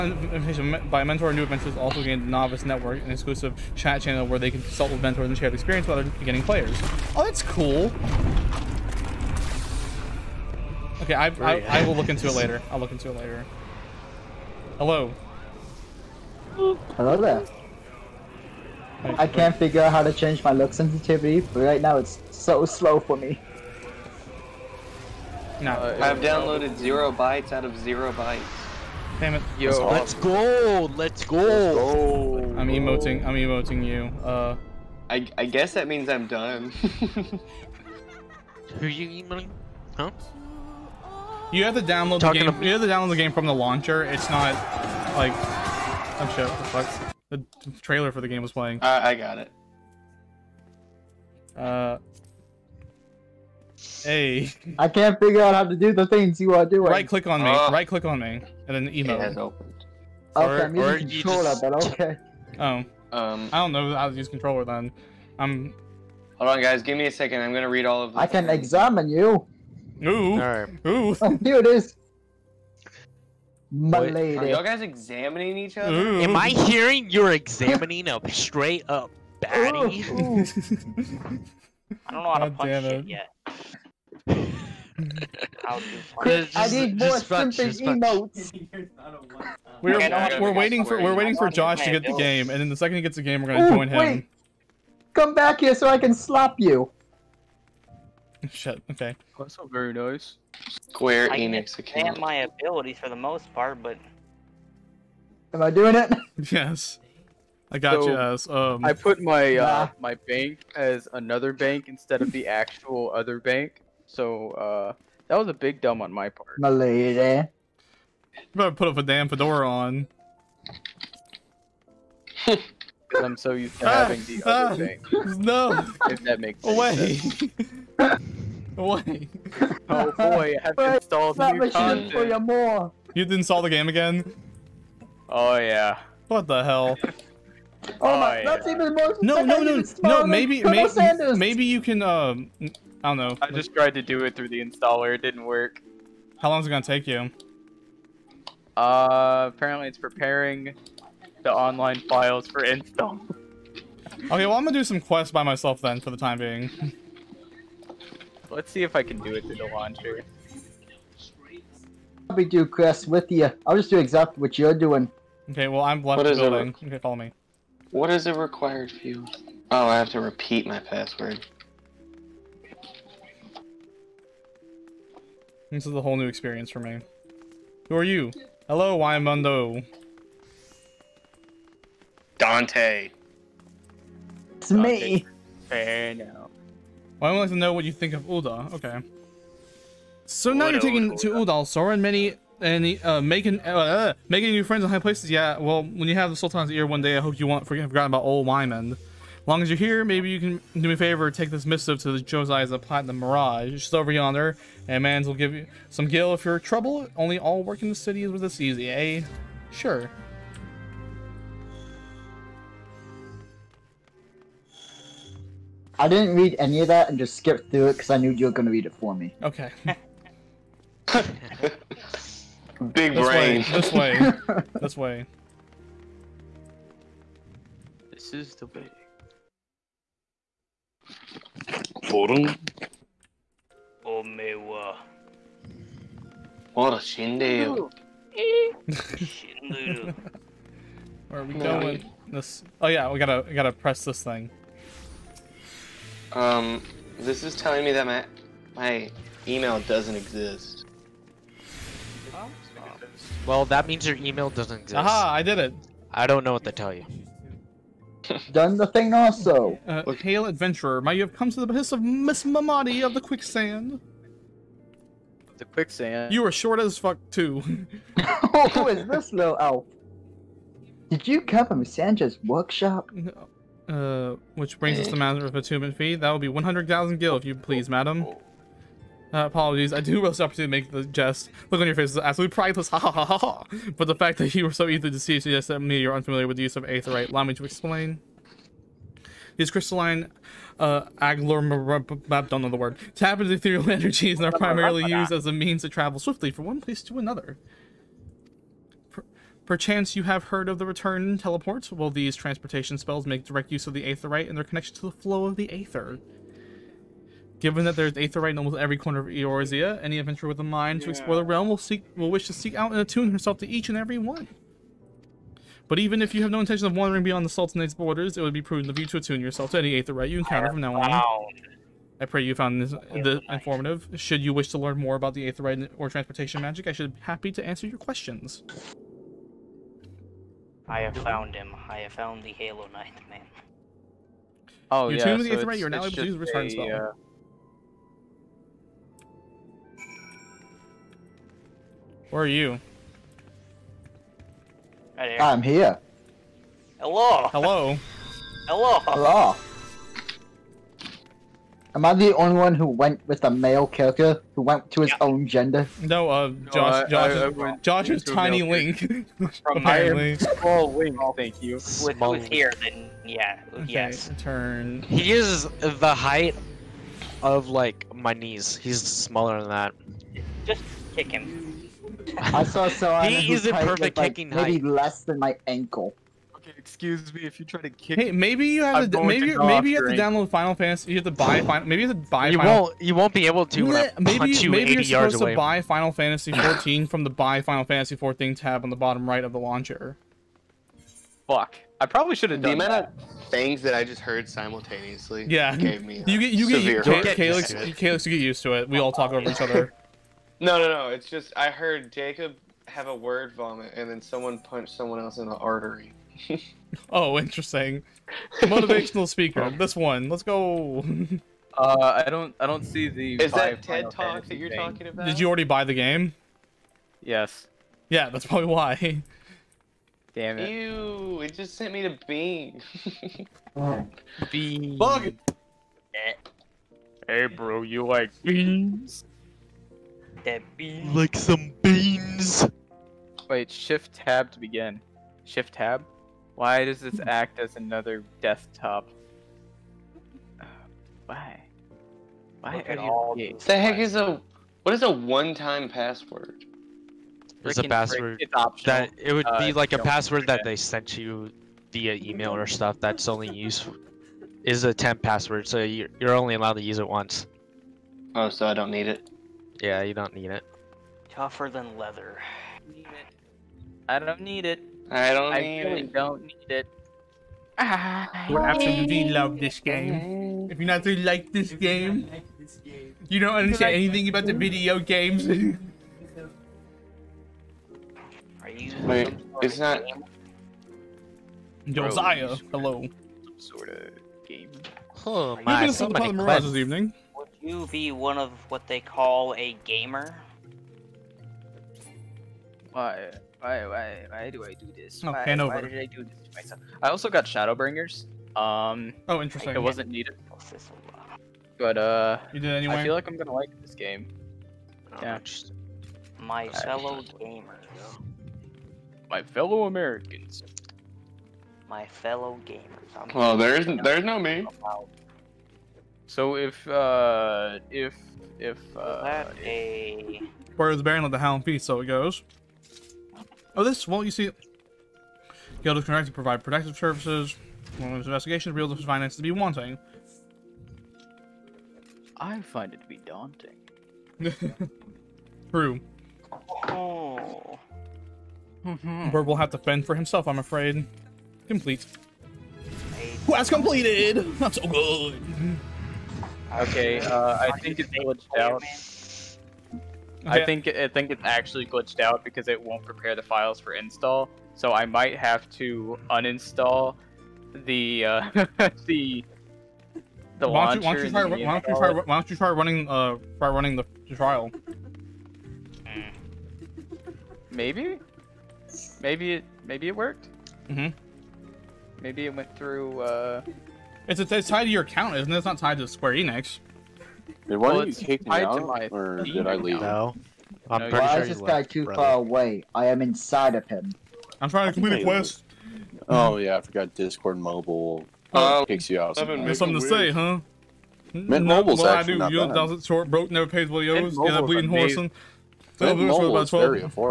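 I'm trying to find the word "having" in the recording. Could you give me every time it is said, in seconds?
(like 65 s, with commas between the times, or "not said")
124 s.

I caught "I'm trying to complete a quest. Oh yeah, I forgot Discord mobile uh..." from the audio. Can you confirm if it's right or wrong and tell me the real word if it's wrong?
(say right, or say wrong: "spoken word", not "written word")
right.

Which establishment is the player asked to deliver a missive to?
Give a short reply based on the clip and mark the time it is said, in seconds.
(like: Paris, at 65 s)
The Platinum Mirage, at 202 s.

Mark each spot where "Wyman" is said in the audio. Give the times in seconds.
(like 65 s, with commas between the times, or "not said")
198 s.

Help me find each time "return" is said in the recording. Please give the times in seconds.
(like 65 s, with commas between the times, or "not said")
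300 s, 336 s.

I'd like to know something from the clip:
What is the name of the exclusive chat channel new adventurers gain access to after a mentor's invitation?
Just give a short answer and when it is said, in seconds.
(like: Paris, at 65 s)
Novice network, at 2 s.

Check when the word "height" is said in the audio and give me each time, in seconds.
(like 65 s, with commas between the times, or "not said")
366 s, 374 s.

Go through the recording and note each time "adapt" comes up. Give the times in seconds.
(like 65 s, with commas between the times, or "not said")
not said.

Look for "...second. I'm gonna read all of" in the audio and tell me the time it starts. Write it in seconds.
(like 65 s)
67 s.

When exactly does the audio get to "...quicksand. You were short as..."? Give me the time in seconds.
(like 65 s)
265 s.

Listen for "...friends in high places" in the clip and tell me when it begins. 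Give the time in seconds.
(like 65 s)
194 s.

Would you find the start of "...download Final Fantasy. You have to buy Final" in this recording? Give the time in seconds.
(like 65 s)
380 s.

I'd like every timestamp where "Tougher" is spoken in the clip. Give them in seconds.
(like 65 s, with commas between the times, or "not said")
461 s.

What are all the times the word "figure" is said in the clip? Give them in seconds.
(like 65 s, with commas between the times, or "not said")
19 s, 55 s.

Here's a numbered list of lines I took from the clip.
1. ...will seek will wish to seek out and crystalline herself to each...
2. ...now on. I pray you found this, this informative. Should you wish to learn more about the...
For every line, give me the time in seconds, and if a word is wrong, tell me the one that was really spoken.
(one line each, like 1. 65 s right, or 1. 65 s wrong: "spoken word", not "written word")
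1. 311 s wrong: "attune", not "crystalline"
2. 320 s right.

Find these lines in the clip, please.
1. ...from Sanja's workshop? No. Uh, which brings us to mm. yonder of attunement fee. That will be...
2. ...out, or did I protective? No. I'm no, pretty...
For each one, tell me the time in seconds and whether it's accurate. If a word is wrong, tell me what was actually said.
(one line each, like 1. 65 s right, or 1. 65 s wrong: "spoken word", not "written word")
1. 271 s wrong: "matter", not "yonder"
2. 578 s wrong: "leave", not "protective".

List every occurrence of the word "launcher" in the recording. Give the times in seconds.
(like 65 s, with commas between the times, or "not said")
43 s, 159 s, 389 s.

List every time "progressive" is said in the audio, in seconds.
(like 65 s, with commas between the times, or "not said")
not said.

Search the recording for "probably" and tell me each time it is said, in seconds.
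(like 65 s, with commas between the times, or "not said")
162 s, 392 s, 418 s.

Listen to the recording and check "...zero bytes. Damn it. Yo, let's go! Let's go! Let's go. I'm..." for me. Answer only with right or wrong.
right.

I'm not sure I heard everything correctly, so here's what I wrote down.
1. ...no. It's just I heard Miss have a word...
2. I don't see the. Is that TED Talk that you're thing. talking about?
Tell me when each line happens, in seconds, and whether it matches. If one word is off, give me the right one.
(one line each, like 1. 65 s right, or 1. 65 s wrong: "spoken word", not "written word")
1. 400 s wrong: "Jacob", not "Miss"
2. 412 s right.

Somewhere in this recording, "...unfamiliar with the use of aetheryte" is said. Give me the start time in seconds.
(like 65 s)
286 s.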